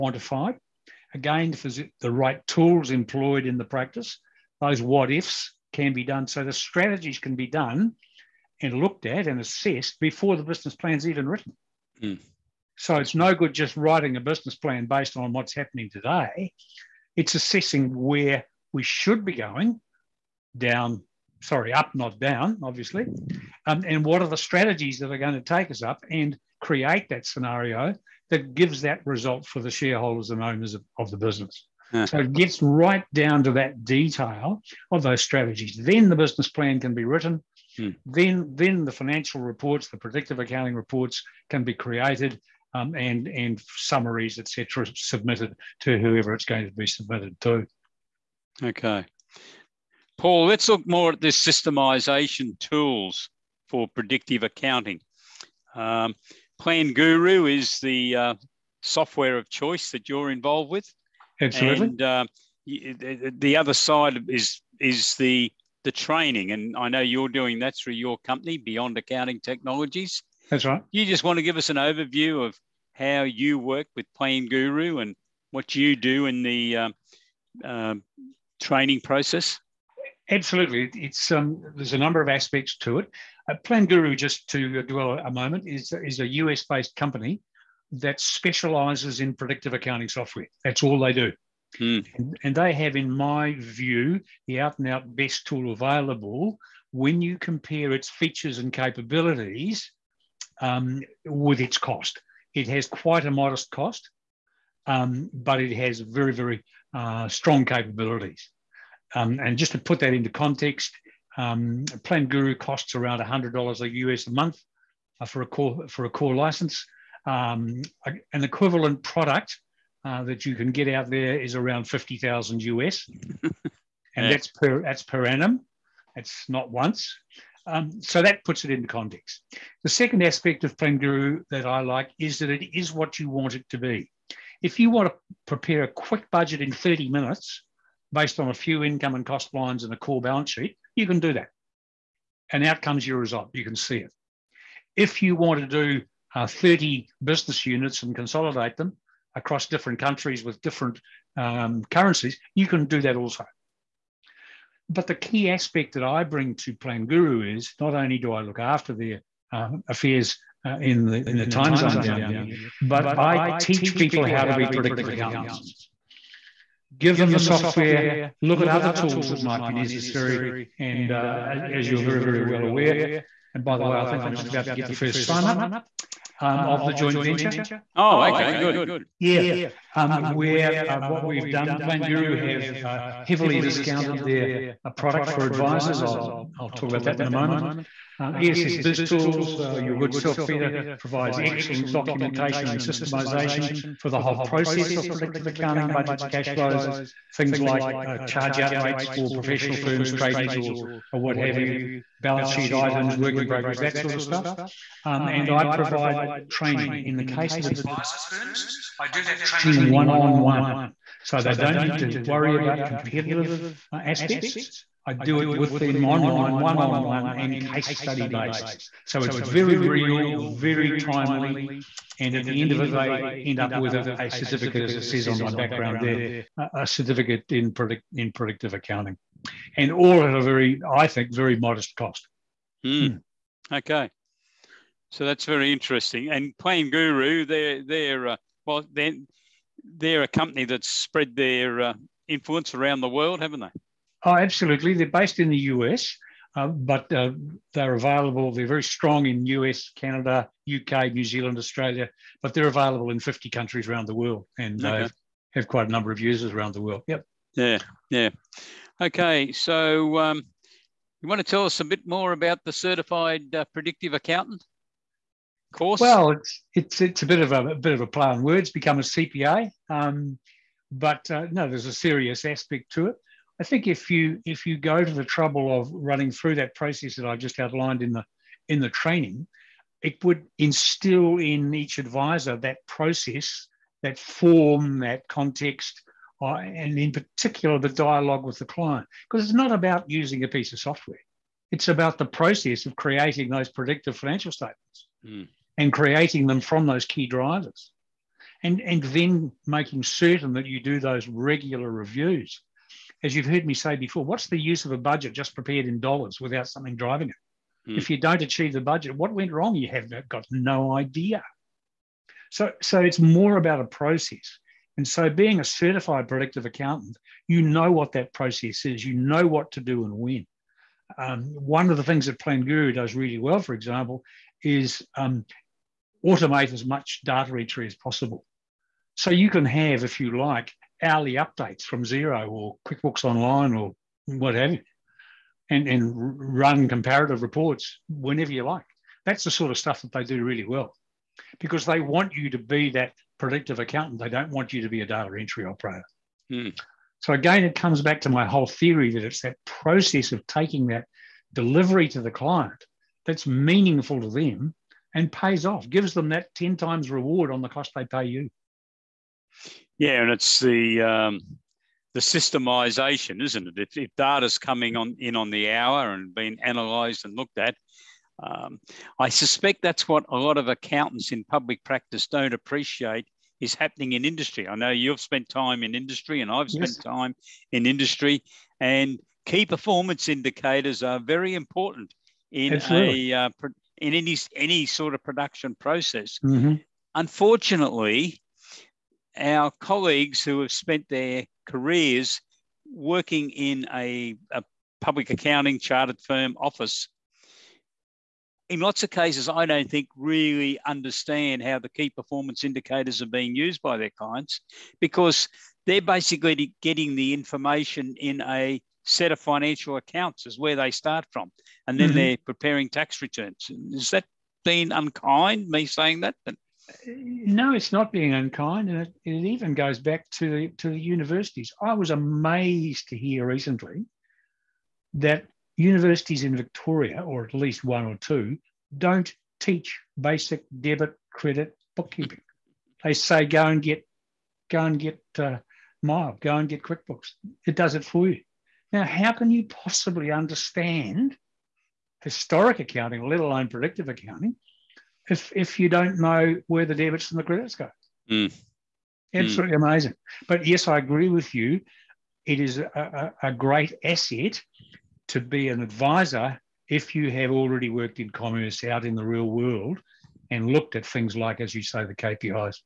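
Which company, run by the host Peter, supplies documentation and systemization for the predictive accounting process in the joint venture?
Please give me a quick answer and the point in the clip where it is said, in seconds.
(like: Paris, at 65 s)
ESS Biz Tools, at 188 s.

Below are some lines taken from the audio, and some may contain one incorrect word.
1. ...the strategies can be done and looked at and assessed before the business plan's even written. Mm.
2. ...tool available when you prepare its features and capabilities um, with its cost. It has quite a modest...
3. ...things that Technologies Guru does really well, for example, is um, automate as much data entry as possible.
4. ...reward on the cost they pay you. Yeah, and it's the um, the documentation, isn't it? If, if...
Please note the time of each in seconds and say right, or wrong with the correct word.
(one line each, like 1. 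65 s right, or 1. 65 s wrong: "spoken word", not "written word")
1. 6 s right
2. 95 s wrong: "compare", not "prepare"
3. 322 s wrong: "Plan", not "Technologies"
4. 357 s wrong: "systemization", not "documentation".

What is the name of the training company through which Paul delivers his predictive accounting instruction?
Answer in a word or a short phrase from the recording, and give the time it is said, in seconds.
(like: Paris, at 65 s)
Beyond Accounting Technologies, at 68 s.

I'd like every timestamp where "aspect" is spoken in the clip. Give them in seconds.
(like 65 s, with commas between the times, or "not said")
82 s, 130 s, 155 s, 213 s, 272 s.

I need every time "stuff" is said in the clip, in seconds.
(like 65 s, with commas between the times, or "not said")
204 s, 339 s.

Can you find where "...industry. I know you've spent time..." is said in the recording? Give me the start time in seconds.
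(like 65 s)
374 s.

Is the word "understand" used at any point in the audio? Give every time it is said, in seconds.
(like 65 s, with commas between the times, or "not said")
400 s, 440 s.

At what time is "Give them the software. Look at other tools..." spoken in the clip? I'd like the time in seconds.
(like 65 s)
166 s.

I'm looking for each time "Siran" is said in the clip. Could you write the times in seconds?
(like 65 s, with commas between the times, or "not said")
not said.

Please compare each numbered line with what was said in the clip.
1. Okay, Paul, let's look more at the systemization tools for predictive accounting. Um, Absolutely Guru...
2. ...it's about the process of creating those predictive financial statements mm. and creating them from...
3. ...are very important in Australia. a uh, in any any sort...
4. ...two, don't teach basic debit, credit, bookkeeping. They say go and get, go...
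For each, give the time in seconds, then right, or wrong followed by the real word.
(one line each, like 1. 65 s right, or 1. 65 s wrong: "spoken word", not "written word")
1. 48 s wrong: "Plan", not "Absolutely"
2. 291 s right
3. 381 s wrong: "Absolutely", not "Australia"
4. 428 s right.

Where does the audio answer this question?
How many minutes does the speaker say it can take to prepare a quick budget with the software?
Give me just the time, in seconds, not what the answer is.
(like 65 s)
136 s.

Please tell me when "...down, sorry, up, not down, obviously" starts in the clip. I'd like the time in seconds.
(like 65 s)
20 s.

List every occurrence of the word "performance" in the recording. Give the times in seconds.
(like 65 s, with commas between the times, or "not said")
379 s, 402 s.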